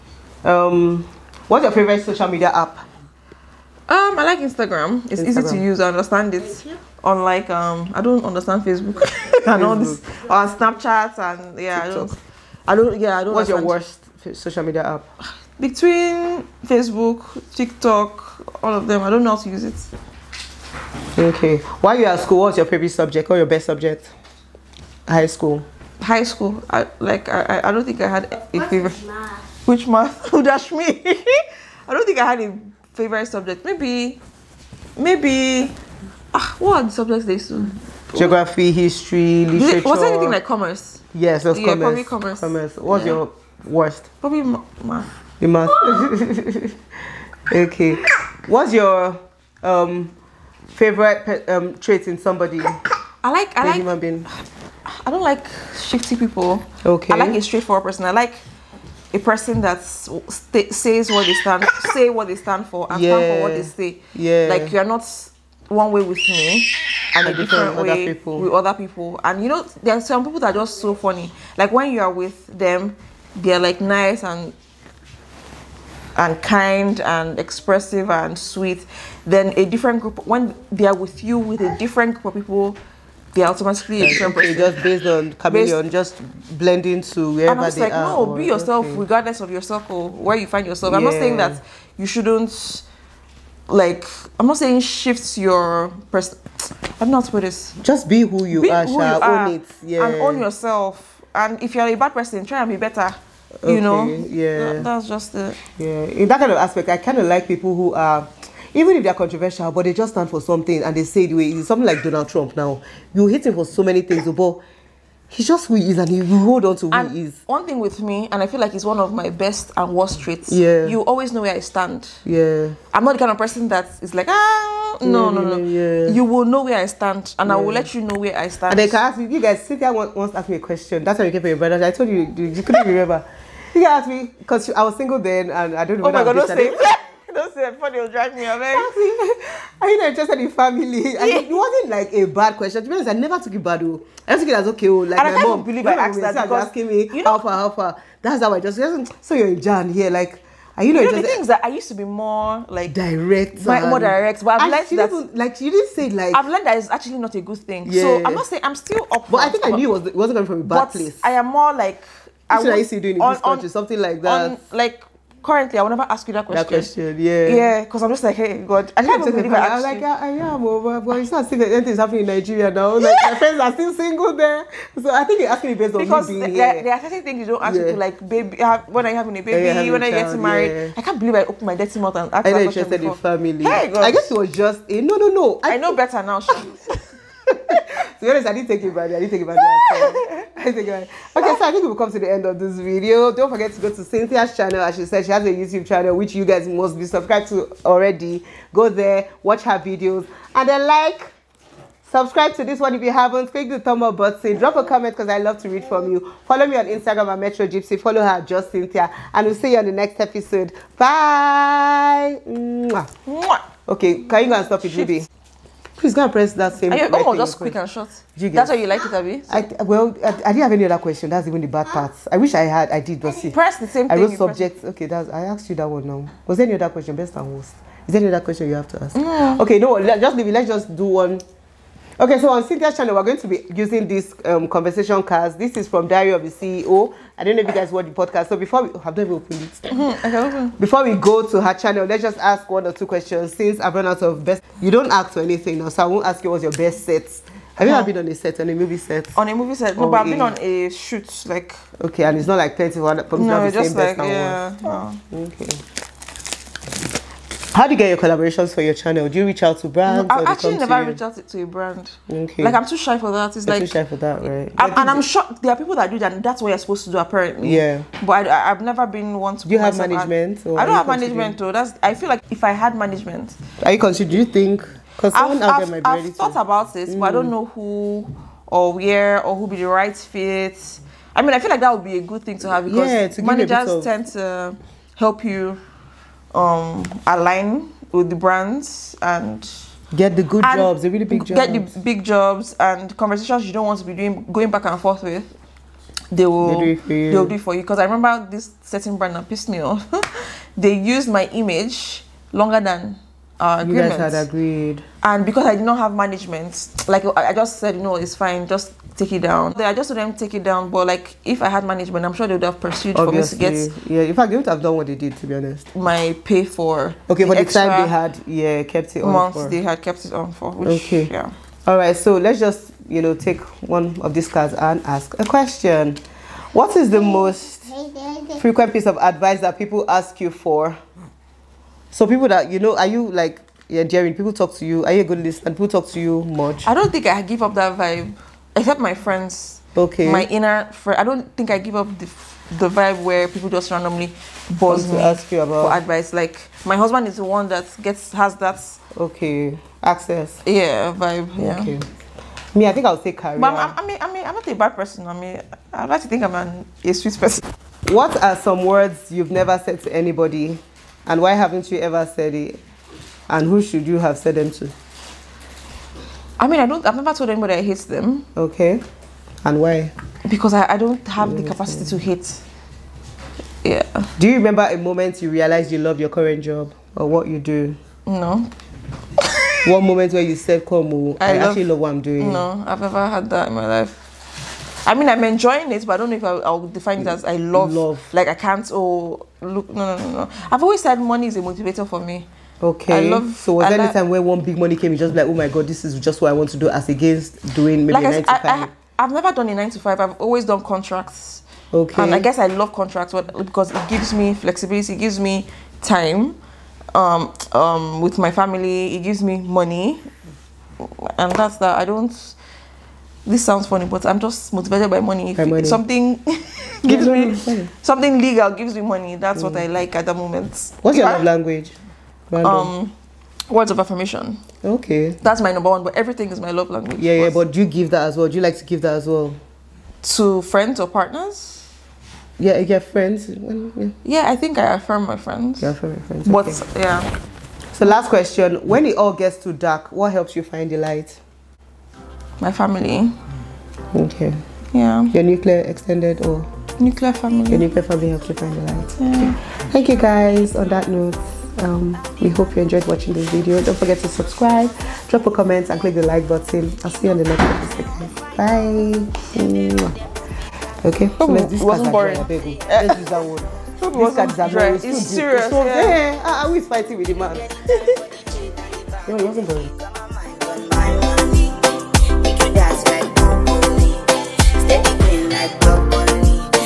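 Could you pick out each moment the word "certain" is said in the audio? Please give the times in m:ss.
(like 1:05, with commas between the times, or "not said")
2:57, 4:58.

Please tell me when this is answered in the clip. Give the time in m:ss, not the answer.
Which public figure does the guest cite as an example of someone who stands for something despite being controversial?
1:52.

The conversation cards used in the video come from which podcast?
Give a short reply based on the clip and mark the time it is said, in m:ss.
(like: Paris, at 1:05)
Diary of the CEO, at 3:56.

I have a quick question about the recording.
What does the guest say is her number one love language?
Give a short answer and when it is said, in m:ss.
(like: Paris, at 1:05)
Words of affirmation, at 7:03.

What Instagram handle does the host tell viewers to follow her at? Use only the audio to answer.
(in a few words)
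MetroGypsie.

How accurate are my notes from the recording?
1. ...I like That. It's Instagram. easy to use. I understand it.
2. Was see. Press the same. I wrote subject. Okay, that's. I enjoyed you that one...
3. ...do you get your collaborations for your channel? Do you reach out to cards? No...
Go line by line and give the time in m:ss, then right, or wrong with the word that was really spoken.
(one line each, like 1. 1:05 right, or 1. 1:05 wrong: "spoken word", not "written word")
1. 0:04 wrong: "Instagram", not "That"
2. 3:43 wrong: "asked", not "enjoyed"
3. 4:17 wrong: "brands", not "cards".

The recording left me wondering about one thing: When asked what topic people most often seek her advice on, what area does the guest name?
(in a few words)
Career.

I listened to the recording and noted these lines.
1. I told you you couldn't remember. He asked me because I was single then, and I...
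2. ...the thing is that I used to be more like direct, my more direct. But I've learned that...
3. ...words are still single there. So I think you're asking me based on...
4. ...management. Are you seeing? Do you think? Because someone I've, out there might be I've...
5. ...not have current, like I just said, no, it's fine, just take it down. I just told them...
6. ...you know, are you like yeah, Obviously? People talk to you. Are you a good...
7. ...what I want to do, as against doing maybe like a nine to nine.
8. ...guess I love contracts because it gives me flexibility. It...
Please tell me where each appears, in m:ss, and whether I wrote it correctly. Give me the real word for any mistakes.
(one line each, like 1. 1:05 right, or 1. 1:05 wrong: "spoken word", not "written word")
1. 2:11 right
2. 2:31 right
3. 2:53 wrong: "friends", not "words"
4. 4:32 wrong: "considering", not "seeing"
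5. 5:05 wrong: "management", not "current"
6. 5:32 wrong: "Jerry", not "Obviously"
7. 6:36 wrong: "five", not "nine"
8. 6:42 right.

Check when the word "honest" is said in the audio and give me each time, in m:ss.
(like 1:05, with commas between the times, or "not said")
2:22, 3:08, 5:15.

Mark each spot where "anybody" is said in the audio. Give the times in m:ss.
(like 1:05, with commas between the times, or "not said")
6:00, 6:07.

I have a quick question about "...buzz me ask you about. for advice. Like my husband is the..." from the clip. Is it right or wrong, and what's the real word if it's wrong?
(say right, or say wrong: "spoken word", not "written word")
right.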